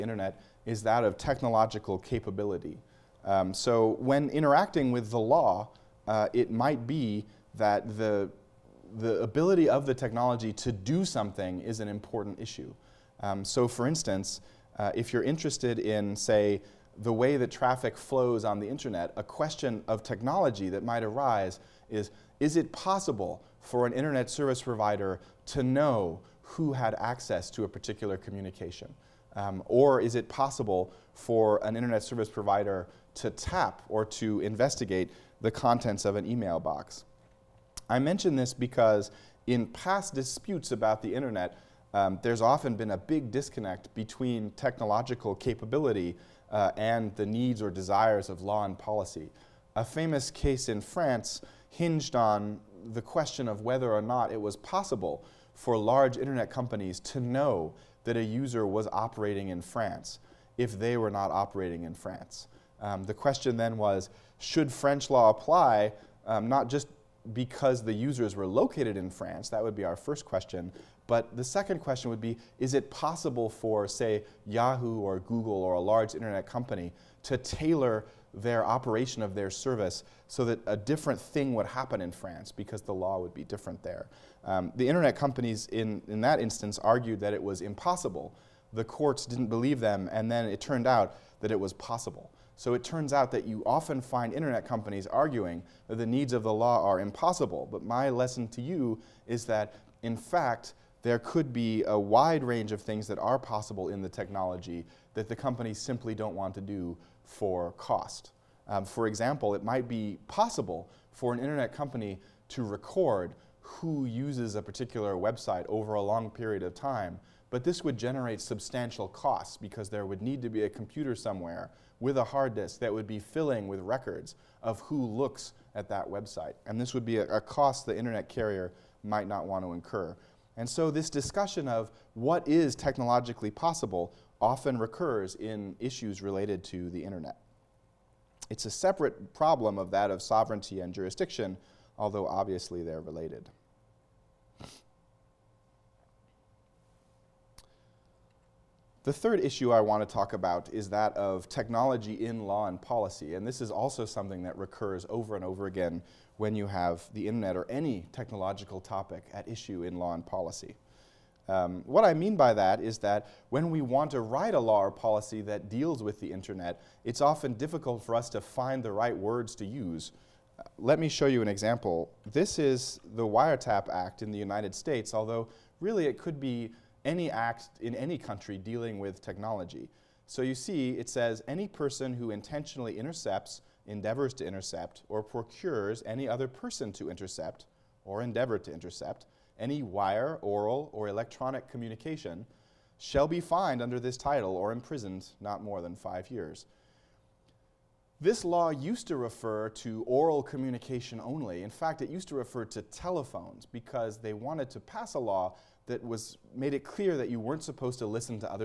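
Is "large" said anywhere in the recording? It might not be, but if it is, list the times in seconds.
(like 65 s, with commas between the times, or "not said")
55 s, 75 s.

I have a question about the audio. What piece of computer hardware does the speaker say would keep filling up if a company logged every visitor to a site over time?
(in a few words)
hard disk.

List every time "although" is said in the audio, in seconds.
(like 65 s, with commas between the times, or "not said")
141 s, 175 s.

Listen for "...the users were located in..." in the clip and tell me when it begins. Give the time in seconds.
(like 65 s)
67 s.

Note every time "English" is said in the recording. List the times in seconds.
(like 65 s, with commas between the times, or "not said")
not said.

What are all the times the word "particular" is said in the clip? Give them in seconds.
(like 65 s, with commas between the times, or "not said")
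27 s, 114 s.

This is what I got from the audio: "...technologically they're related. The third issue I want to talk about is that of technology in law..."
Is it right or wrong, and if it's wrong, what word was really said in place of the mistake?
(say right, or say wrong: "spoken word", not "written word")
wrong: "obviously", not "technologically".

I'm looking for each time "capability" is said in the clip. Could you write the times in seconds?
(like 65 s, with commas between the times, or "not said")
1 s, 45 s.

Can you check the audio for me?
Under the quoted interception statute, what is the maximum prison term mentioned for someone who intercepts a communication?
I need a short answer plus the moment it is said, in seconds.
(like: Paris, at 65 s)
5 years, at 195 s.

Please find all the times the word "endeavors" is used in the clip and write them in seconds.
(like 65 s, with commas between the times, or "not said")
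183 s, 188 s.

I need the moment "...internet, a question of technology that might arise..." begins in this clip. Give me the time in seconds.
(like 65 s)
18 s.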